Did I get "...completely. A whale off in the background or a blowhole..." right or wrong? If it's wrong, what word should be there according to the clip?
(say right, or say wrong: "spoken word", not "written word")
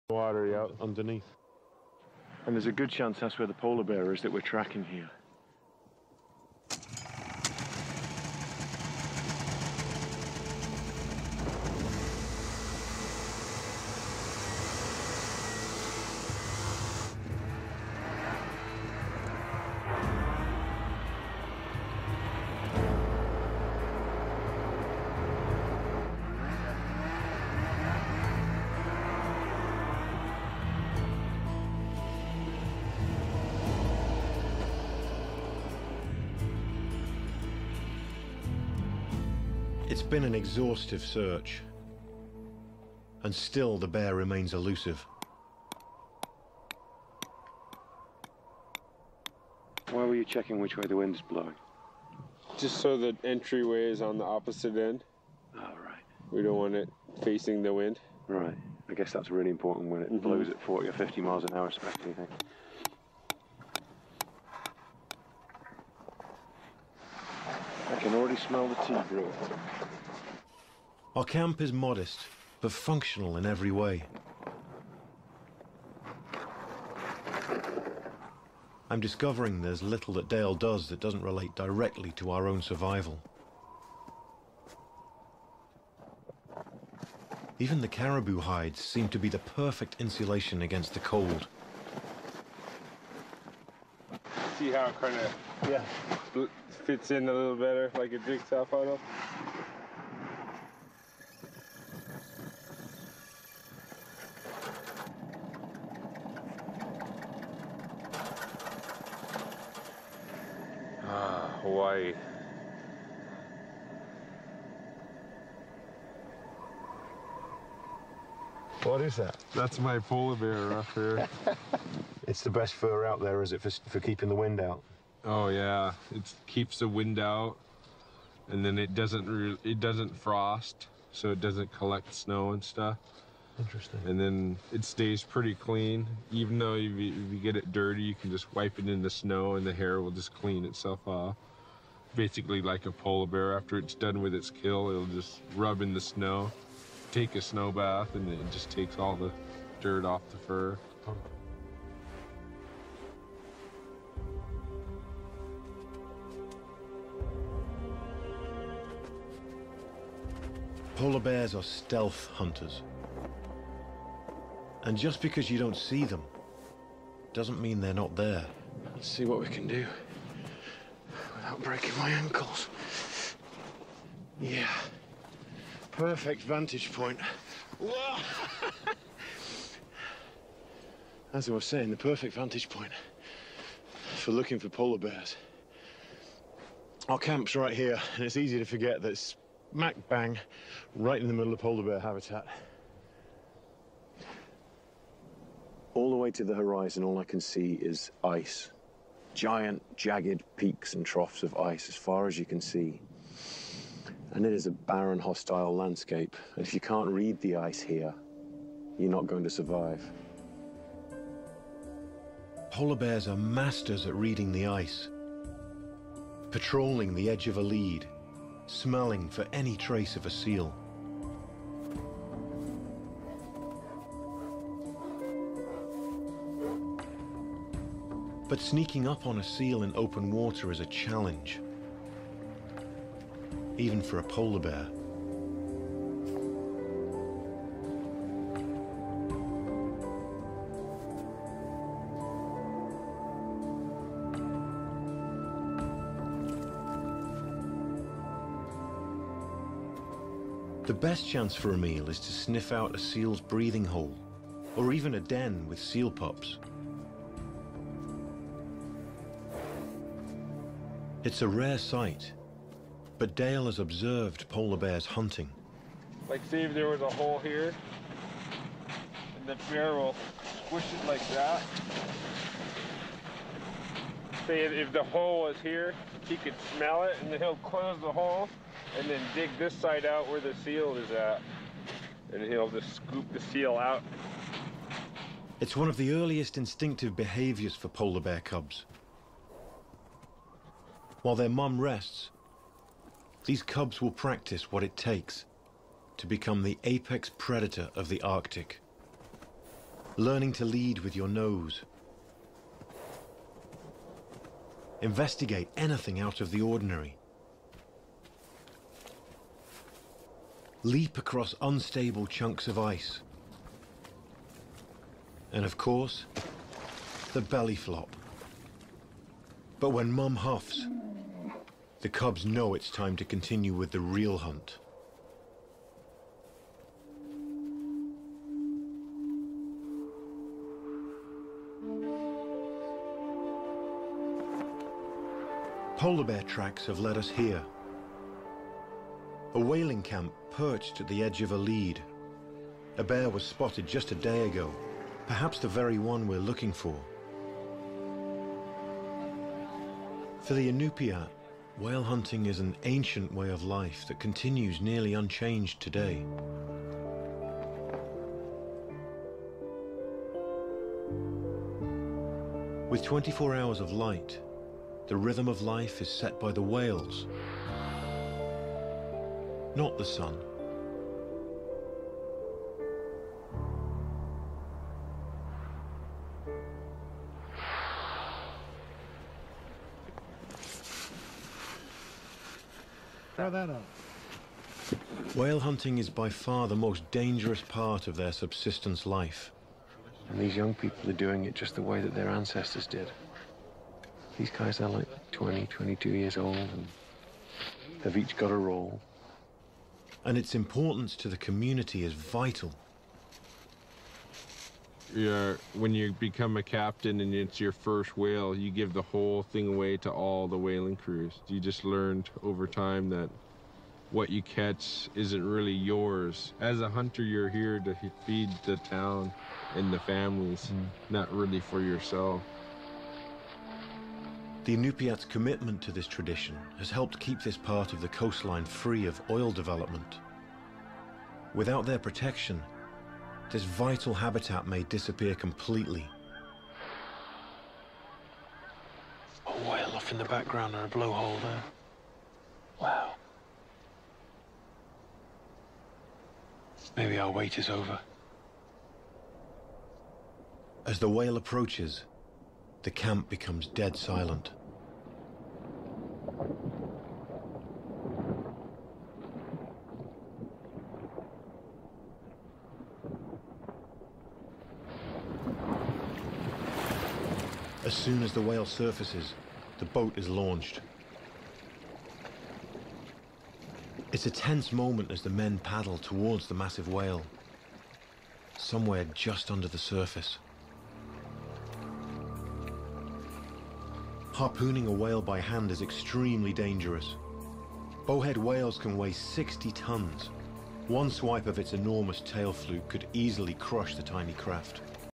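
right.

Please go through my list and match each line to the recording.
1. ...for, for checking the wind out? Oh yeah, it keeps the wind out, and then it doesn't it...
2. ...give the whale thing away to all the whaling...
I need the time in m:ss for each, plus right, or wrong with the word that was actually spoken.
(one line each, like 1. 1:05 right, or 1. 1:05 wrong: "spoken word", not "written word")
1. 2:03 wrong: "keeping", not "checking"
2. 6:48 wrong: "whole", not "whale".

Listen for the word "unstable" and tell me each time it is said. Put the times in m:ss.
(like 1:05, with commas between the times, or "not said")
5:11.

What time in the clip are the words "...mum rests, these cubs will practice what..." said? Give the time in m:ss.
4:51.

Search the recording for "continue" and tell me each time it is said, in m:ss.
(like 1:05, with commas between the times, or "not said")
5:23, 5:54.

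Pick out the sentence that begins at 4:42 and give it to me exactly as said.
And he'll just scoop the seal out.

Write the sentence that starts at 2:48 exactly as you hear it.
Let's see what we can do without breaking my ankles.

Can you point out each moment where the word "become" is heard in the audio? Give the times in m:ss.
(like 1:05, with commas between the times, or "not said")
4:56, 6:46, 7:33.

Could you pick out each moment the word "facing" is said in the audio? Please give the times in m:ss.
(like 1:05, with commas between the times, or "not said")
0:57.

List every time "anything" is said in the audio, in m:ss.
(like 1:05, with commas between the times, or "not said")
5:05.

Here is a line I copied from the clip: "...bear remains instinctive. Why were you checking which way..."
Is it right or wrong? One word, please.
wrong.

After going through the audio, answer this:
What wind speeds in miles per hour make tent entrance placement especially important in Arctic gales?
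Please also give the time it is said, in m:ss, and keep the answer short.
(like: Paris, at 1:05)
40 or 50, at 1:00.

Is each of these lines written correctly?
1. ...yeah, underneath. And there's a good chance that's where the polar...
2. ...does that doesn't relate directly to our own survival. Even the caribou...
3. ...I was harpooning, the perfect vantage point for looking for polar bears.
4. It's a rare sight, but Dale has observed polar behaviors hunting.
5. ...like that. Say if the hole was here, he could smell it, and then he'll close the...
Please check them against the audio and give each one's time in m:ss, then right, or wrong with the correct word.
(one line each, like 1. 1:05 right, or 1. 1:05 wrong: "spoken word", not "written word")
1. 0:00 right
2. 1:20 right
3. 3:01 wrong: "saying", not "harpooning"
4. 4:21 wrong: "bears", not "behaviors"
5. 4:31 right.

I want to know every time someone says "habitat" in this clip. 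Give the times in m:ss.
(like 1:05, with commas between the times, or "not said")
3:11, 7:14.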